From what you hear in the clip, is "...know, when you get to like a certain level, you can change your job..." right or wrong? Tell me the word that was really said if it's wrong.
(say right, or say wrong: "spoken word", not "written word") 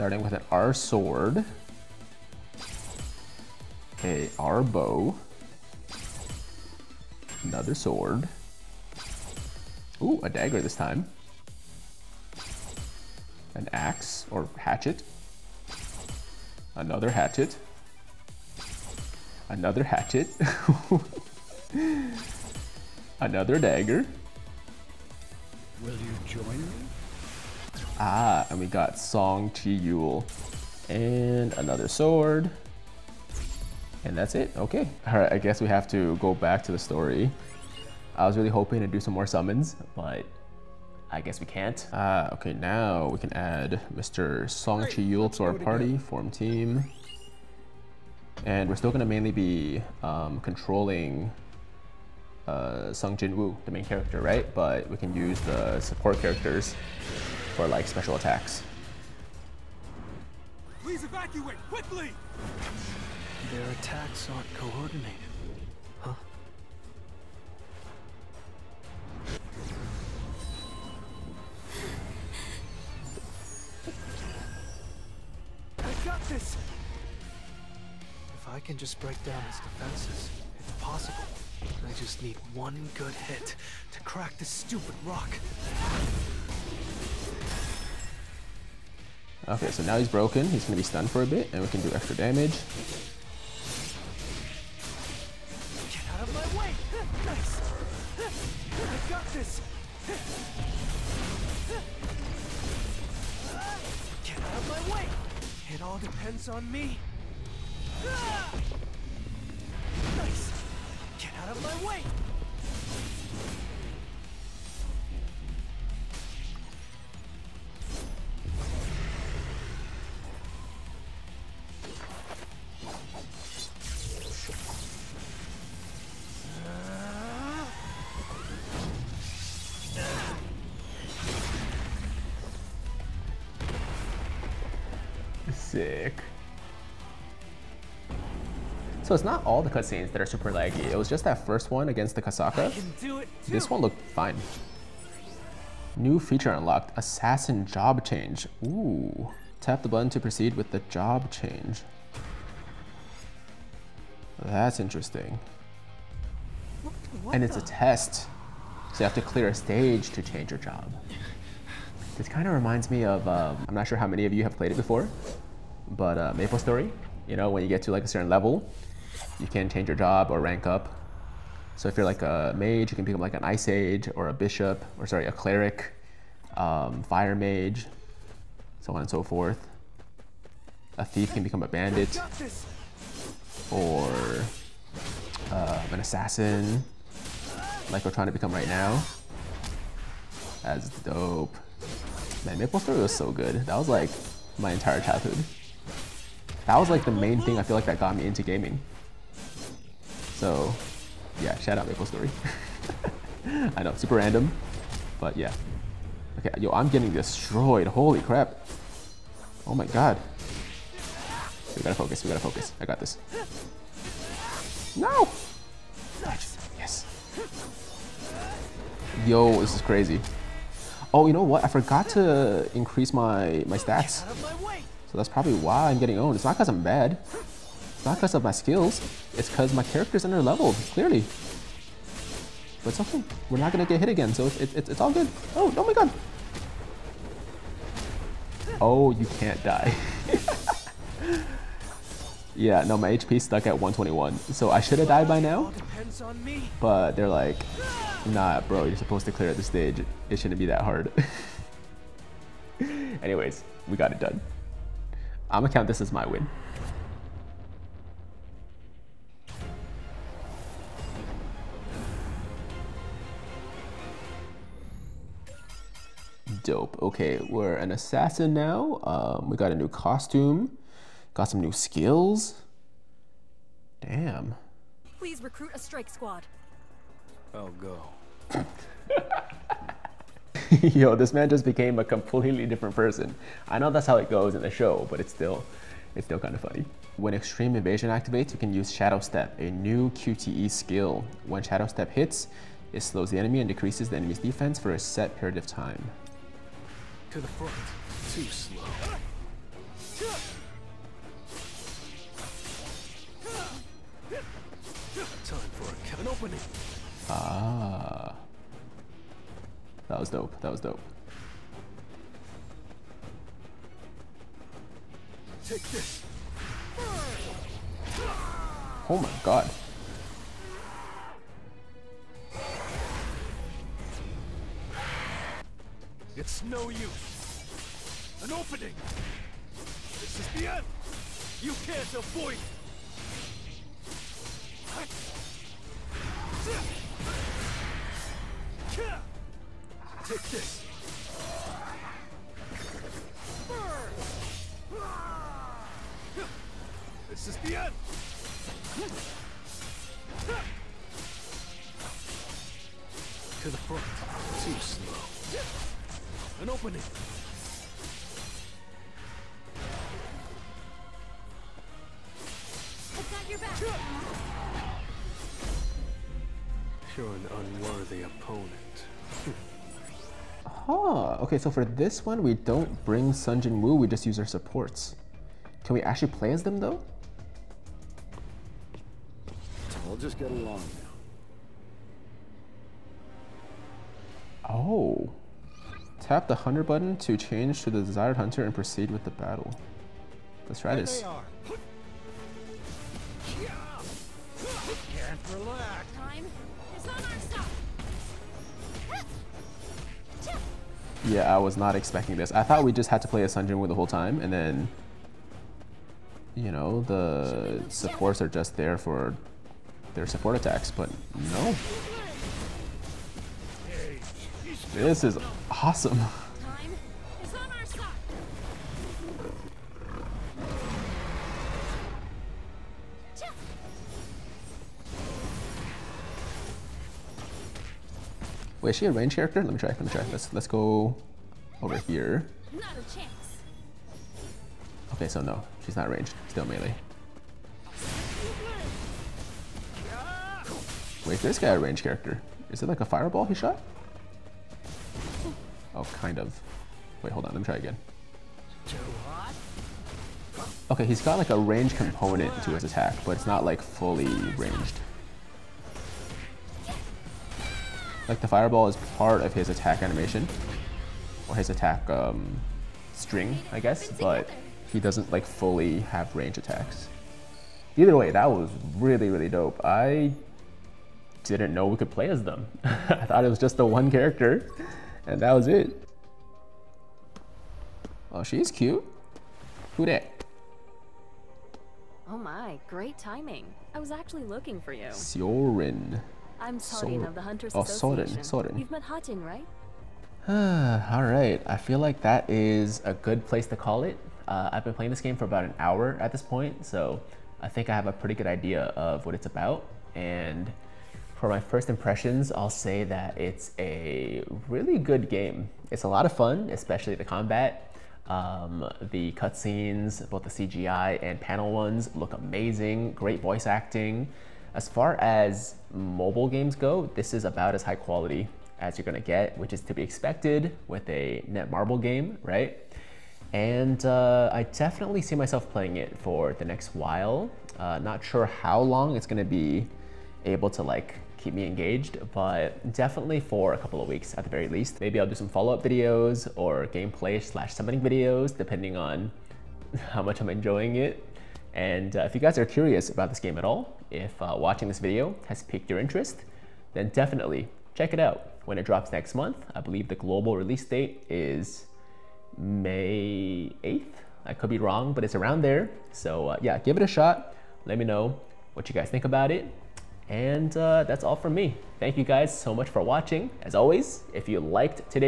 right.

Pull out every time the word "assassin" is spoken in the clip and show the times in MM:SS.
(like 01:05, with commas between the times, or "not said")
02:26, 03:06, 04:27.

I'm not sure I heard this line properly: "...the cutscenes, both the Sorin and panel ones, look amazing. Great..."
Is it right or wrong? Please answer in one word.
wrong.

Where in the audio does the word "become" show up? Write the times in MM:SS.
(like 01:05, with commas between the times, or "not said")
02:53, 03:01, 03:08.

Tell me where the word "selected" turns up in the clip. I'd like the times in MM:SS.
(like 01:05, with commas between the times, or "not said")
not said.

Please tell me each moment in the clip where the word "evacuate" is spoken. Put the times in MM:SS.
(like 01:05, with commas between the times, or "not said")
01:01.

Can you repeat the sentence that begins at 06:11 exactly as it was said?
Okay, so for this one, we don't bring Sung Jin Woo, we just use our supports.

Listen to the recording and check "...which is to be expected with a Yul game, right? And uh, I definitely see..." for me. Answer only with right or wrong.
wrong.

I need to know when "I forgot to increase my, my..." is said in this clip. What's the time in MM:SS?
03:41.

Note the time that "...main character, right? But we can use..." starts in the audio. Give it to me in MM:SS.
00:53.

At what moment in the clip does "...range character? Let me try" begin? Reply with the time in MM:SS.
07:09.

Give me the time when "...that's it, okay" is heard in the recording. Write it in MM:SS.
00:34.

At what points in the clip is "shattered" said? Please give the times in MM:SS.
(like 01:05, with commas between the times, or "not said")
not said.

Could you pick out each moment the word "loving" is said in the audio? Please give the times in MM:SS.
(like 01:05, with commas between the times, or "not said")
not said.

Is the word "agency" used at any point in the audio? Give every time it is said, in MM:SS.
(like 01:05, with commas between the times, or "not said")
not said.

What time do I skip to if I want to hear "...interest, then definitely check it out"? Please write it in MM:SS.
09:05.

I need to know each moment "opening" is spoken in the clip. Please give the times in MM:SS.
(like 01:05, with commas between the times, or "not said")
05:06, 05:28, 05:56.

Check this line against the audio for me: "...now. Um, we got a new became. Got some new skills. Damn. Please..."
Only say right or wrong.
wrong.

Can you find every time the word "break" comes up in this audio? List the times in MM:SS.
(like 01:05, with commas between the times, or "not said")
01:18.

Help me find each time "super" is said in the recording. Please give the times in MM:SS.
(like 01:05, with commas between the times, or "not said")
02:20, 03:23.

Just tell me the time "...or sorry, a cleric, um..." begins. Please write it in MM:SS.
02:54.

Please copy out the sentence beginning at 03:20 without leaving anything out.
So yeah, shout out Maple Story.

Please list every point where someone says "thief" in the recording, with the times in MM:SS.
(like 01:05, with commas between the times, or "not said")
03:01.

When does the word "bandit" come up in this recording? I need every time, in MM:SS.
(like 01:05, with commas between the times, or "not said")
03:01.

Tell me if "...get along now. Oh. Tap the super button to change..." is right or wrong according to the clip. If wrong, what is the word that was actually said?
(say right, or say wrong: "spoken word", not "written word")
wrong: "hunter", not "super".